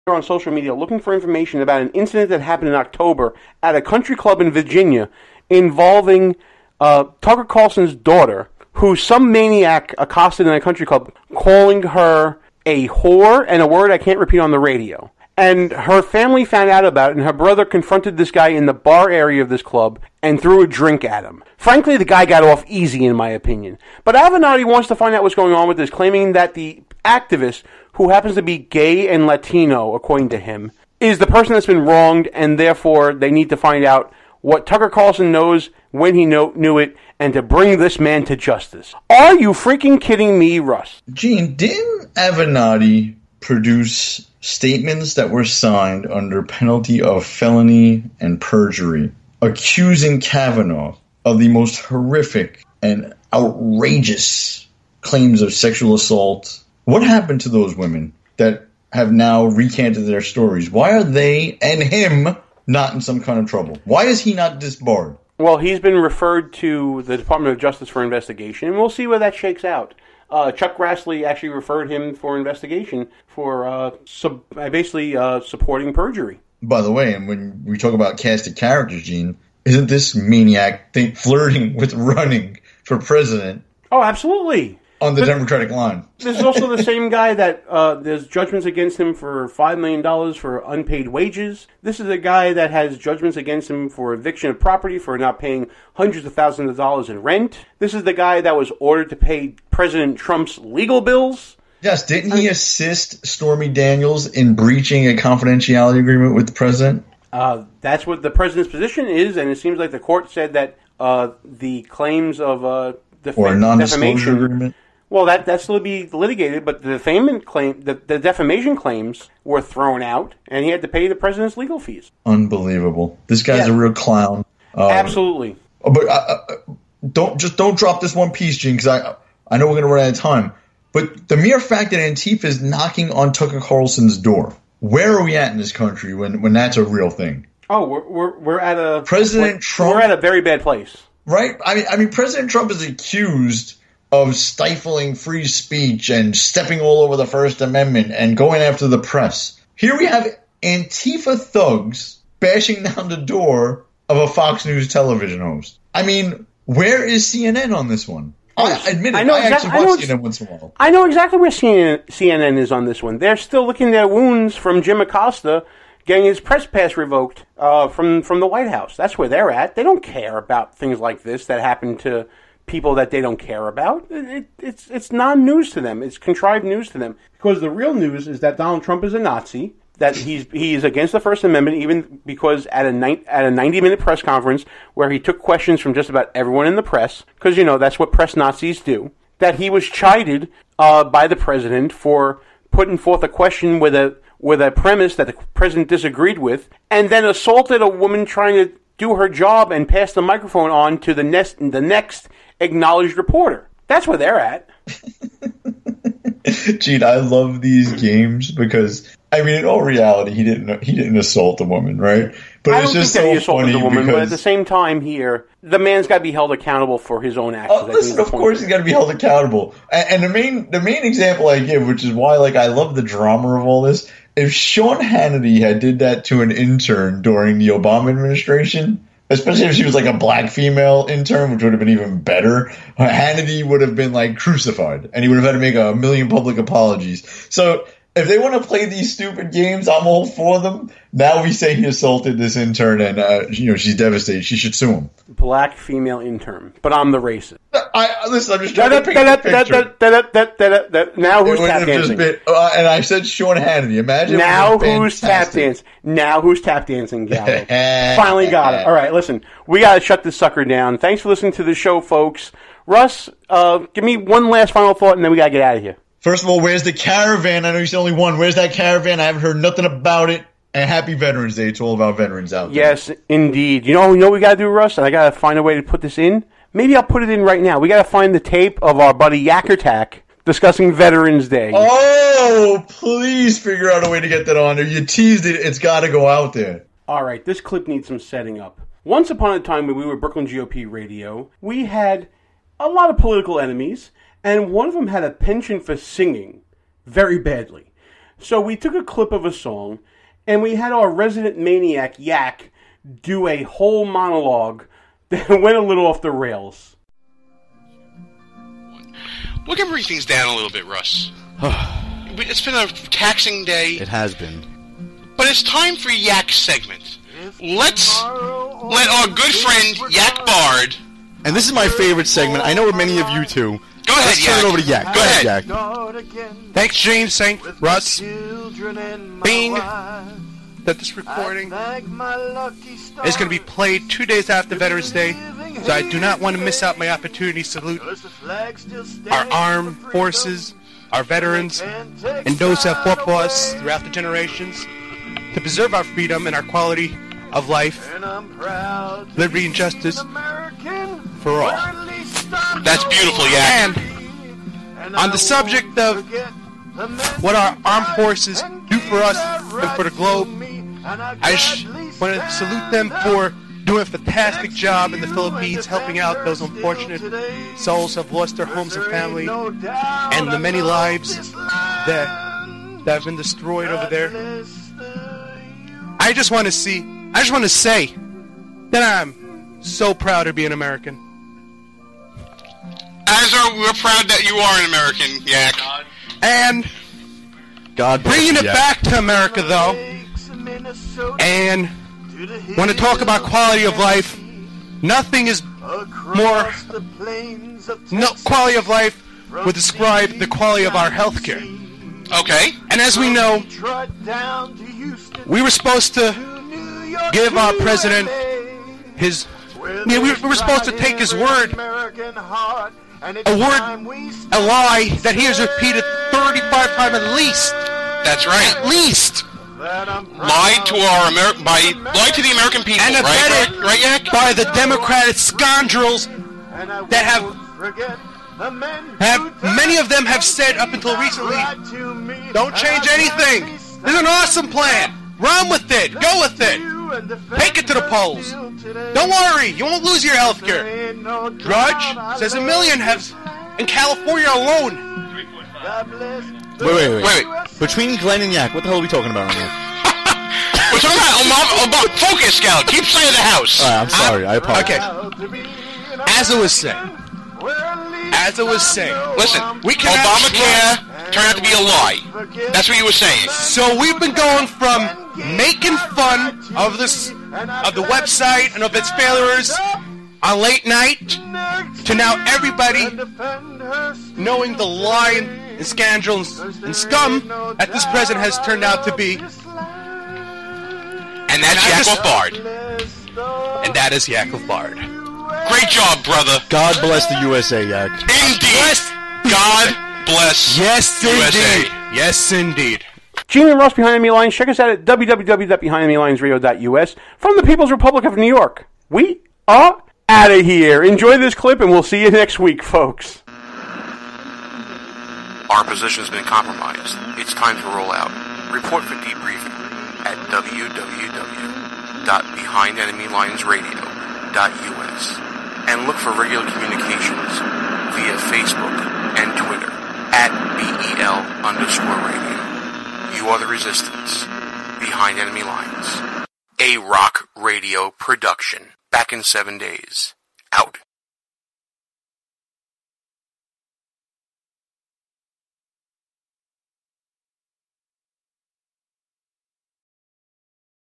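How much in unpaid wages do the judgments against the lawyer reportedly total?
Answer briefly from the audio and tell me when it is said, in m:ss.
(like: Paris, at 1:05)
5 million dollars, at 1:29.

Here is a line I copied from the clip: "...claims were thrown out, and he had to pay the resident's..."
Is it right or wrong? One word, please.
wrong.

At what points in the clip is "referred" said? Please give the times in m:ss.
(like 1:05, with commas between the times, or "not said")
1:05, 1:11.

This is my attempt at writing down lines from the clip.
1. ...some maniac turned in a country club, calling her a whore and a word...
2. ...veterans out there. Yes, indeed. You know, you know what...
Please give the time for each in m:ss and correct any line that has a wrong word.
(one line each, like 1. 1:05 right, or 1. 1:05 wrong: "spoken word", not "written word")
1. 0:08 wrong: "accosted", not "turned"
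2. 4:32 right.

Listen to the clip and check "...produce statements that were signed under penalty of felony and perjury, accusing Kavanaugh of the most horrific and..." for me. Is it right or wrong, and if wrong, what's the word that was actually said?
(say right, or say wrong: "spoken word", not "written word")
right.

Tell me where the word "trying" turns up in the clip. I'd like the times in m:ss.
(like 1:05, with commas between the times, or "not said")
3:18, 4:08.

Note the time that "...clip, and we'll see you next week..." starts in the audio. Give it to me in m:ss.
8:21.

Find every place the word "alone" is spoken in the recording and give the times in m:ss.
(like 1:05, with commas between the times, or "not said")
7:24.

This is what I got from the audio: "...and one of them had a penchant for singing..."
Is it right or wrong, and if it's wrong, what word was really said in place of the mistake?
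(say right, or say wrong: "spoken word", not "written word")
right.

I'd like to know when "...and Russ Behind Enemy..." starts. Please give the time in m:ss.
8:13.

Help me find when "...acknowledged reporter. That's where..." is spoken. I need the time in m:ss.
3:22.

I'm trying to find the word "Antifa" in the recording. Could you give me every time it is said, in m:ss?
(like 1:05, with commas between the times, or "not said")
2:11, 2:30.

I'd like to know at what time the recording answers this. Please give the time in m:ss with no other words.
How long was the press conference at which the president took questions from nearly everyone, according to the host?
3:03.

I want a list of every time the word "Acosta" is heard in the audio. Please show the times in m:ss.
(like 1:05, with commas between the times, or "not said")
2:44.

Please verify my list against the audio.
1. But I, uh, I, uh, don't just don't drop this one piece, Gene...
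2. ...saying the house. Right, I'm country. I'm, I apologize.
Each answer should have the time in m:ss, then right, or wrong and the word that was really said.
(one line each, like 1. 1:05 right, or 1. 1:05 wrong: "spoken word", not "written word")
1. 2:05 right
2. 7:33 wrong: "sorry", not "country".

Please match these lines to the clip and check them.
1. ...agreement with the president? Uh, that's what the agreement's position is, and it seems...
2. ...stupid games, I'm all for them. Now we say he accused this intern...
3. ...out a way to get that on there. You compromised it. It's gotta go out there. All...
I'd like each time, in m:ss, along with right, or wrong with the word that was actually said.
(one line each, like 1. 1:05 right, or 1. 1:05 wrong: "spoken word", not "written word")
1. 1:45 wrong: "president", not "agreement"
2. 3:59 wrong: "assaulted", not "accused"
3. 4:43 wrong: "teased", not "compromised".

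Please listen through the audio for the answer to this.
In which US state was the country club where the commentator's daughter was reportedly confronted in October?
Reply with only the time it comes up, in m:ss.
0:04.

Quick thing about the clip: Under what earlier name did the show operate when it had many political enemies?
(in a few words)
Brooklyn GOP radio.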